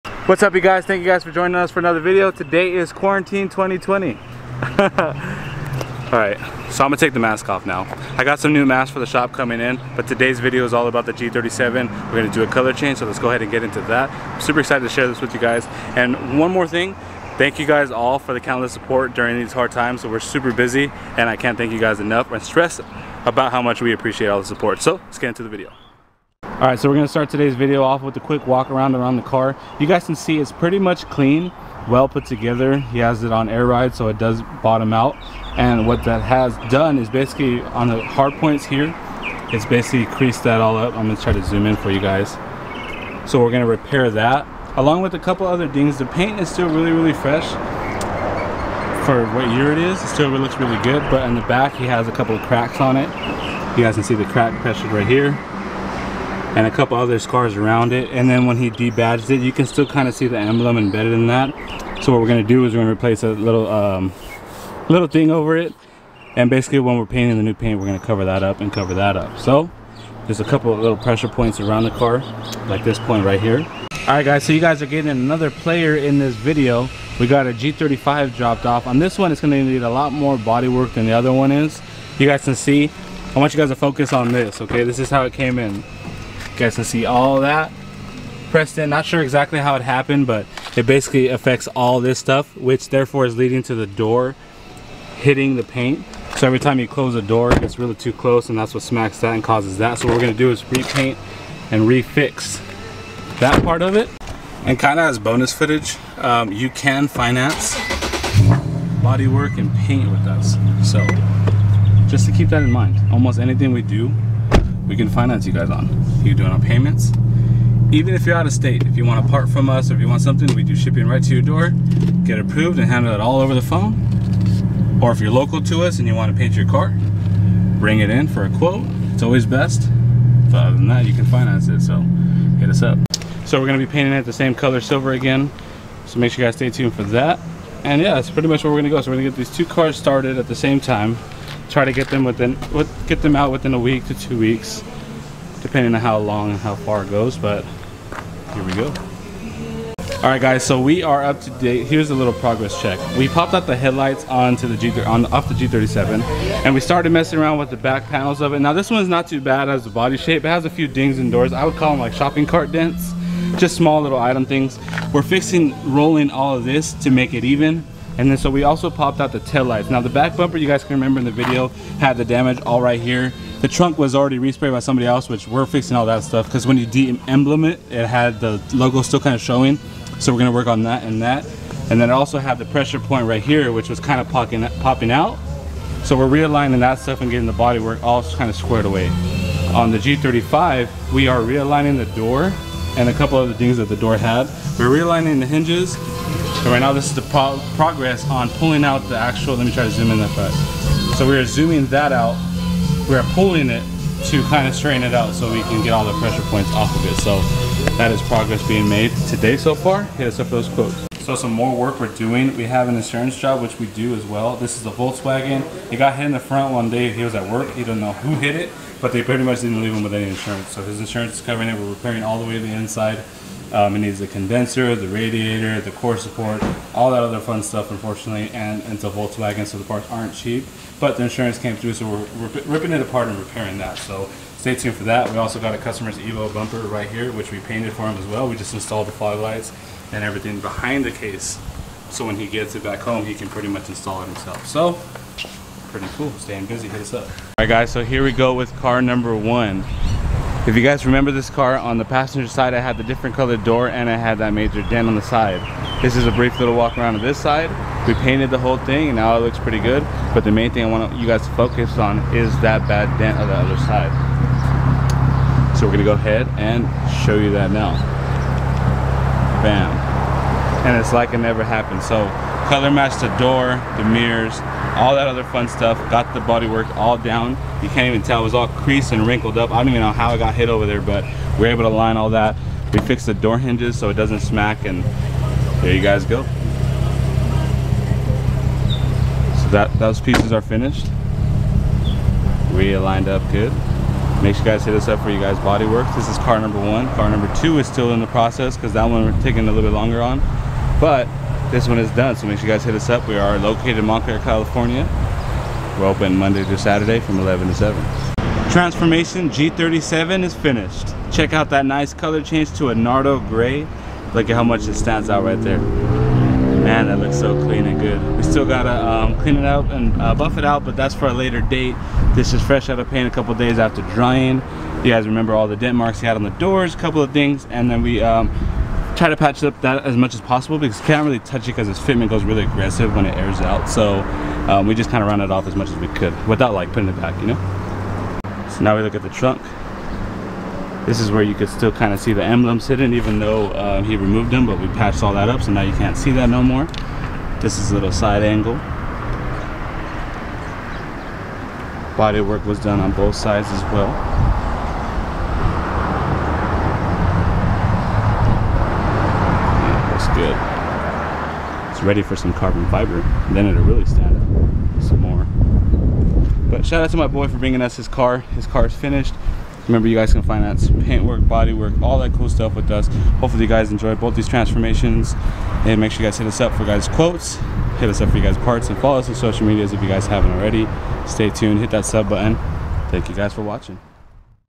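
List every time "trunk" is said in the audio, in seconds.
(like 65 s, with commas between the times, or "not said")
173 s, 339 s.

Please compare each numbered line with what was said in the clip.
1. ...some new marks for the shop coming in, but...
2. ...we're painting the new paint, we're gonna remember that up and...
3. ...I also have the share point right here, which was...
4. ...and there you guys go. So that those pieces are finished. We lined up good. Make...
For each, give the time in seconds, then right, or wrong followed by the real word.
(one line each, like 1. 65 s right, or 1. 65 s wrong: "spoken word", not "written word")
1. 8 s wrong: "masks", not "marks"
2. 66 s wrong: "cover", not "remember"
3. 182 s wrong: "pressure", not "share"
4. 284 s right.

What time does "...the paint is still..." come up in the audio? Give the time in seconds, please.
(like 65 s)
45 s.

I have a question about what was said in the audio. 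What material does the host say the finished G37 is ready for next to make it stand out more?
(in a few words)
Carbon fiber.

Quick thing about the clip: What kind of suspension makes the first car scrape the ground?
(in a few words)
Air ride.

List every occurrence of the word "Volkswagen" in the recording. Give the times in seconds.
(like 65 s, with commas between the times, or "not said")
214 s, 229 s.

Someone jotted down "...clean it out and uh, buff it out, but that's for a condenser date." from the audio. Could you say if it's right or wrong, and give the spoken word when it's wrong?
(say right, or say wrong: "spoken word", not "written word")
wrong: "later", not "condenser".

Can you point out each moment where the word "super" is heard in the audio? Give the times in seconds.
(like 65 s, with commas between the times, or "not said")
14 s, 20 s.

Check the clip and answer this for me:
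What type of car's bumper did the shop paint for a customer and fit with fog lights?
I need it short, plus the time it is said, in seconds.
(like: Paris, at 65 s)
Evo, at 236 s.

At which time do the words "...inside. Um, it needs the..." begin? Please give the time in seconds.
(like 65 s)
222 s.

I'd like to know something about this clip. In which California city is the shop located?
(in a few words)
Montclair.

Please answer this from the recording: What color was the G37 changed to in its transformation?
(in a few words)
Nardo gray.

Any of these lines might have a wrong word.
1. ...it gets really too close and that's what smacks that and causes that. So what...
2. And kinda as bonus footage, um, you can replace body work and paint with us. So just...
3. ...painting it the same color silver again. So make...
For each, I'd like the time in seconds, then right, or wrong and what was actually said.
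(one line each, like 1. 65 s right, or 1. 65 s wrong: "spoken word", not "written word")
1. 97 s right
2. 104 s wrong: "finance", not "replace"
3. 133 s right.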